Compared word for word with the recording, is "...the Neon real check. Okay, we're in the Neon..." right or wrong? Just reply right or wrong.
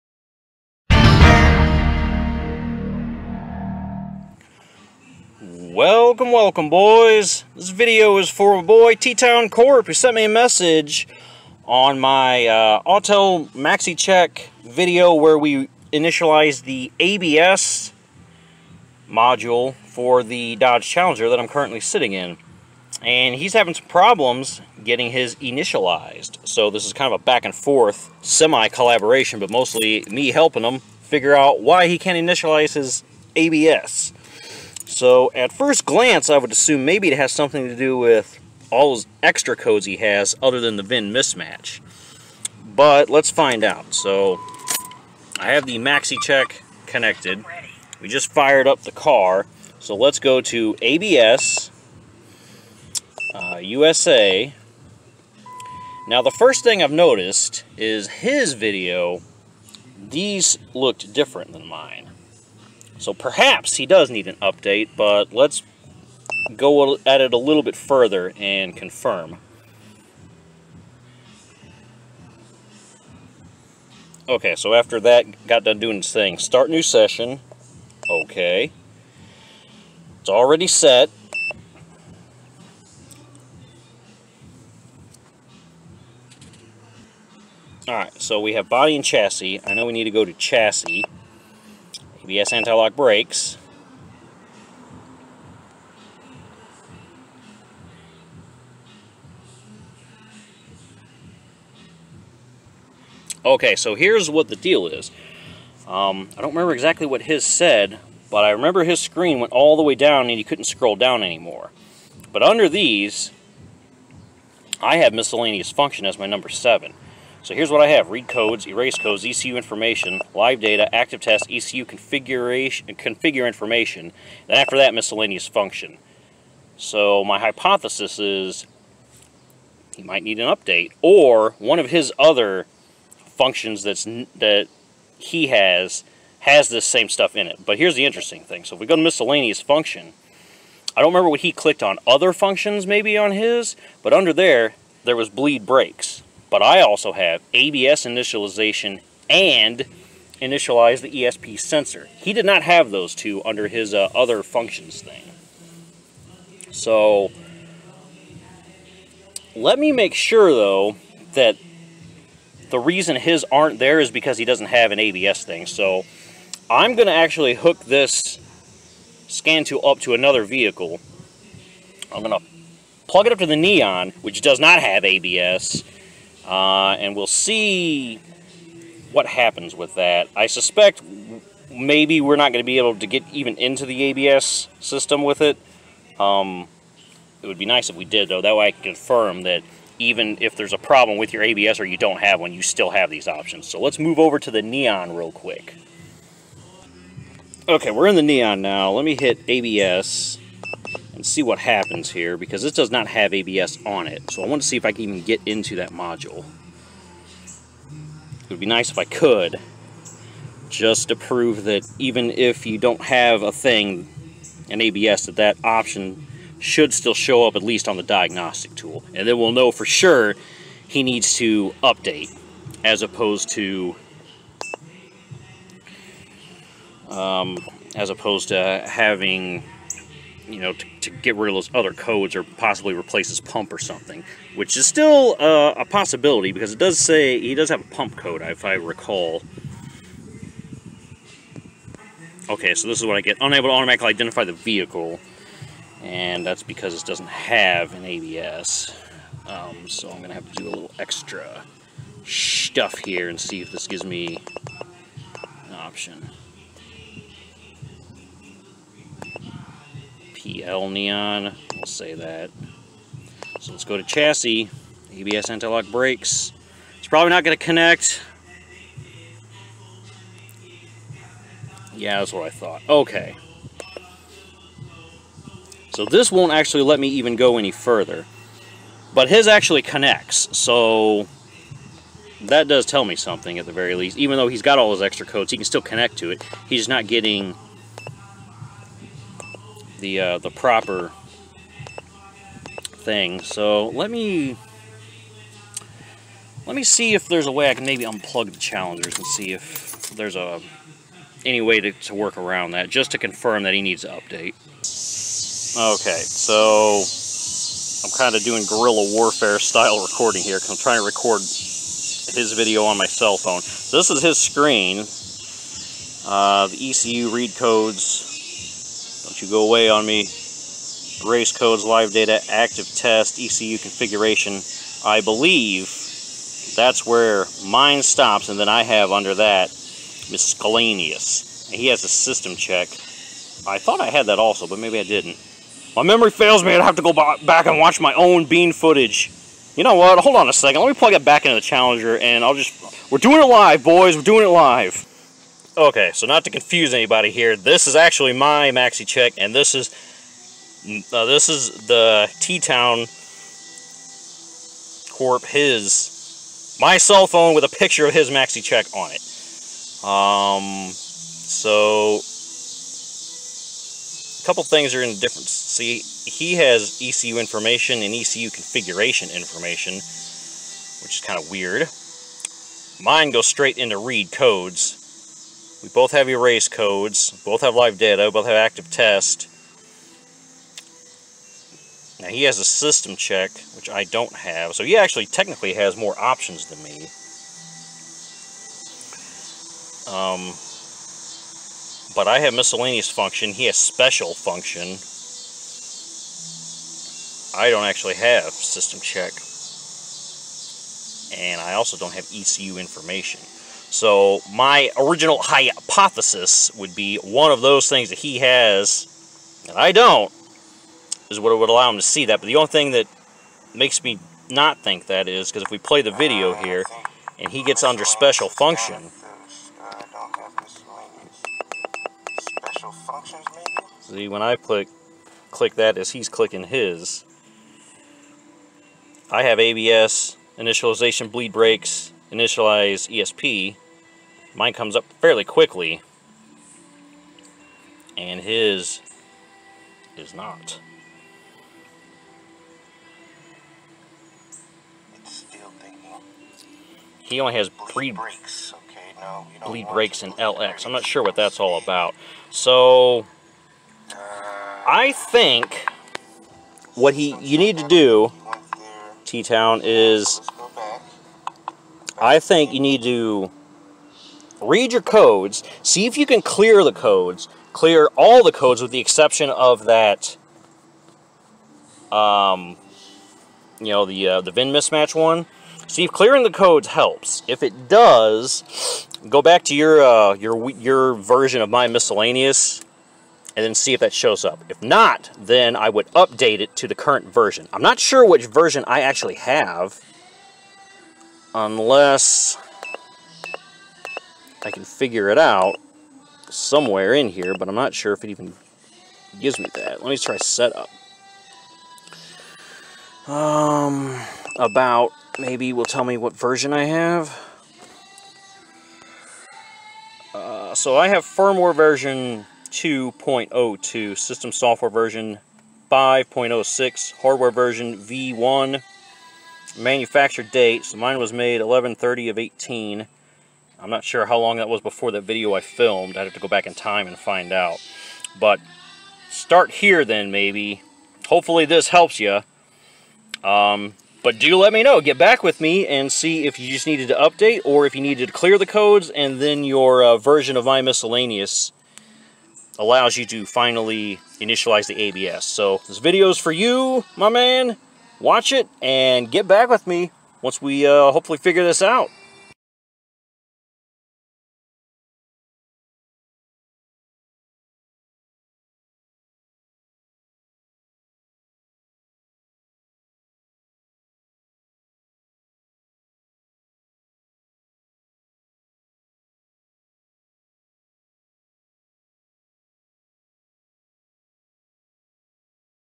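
wrong.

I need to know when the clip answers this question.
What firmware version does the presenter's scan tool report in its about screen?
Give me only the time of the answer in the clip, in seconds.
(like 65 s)
512 s.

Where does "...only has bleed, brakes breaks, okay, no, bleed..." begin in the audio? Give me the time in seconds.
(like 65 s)
447 s.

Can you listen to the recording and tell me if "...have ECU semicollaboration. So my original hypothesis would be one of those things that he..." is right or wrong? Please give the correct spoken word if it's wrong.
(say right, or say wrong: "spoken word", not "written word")
wrong: "information", not "semicollaboration".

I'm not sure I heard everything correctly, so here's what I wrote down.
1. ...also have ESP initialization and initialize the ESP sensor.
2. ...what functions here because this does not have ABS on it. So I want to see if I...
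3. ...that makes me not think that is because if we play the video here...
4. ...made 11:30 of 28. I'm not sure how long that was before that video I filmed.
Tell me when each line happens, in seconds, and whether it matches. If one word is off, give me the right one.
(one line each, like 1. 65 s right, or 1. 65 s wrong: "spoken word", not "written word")
1. 146 s wrong: "ABS", not "ESP"
2. 201 s wrong: "happens", not "functions"
3. 412 s right
4. 521 s wrong: "18", not "28".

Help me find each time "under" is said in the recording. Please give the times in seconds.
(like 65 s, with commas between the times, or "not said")
112 s, 144 s, 153 s, 329 s, 417 s.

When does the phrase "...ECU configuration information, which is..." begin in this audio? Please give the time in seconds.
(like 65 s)
368 s.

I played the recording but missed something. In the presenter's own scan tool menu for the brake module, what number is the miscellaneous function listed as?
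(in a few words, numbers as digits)
7.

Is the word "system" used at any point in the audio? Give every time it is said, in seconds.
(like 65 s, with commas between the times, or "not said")
184 s, 332 s, 382 s, 398 s, 514 s.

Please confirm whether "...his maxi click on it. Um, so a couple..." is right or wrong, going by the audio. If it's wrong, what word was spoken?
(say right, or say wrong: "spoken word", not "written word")
wrong: "check", not "click".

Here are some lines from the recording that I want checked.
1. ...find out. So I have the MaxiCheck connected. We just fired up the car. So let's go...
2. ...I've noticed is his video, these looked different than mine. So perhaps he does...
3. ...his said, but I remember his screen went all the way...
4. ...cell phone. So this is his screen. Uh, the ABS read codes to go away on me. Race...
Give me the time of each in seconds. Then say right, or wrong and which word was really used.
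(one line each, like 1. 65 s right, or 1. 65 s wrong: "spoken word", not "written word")
1. 43 s right
2. 56 s right
3. 107 s right
4. 313 s wrong: "ECU", not "ABS".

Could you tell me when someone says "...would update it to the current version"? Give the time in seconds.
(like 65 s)
485 s.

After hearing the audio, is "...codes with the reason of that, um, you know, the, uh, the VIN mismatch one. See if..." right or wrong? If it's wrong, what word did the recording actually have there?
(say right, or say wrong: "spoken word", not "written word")
wrong: "exception", not "reason".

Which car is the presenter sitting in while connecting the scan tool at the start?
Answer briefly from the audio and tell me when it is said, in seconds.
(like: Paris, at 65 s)
Dodge Challenger, at 20 s.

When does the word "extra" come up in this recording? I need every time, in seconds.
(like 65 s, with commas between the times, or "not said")
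39 s, 250 s, 285 s.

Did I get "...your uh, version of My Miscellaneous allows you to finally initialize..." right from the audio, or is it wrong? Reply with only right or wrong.
right.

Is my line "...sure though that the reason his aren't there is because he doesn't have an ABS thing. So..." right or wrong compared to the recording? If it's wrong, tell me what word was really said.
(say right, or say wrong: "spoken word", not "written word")
right.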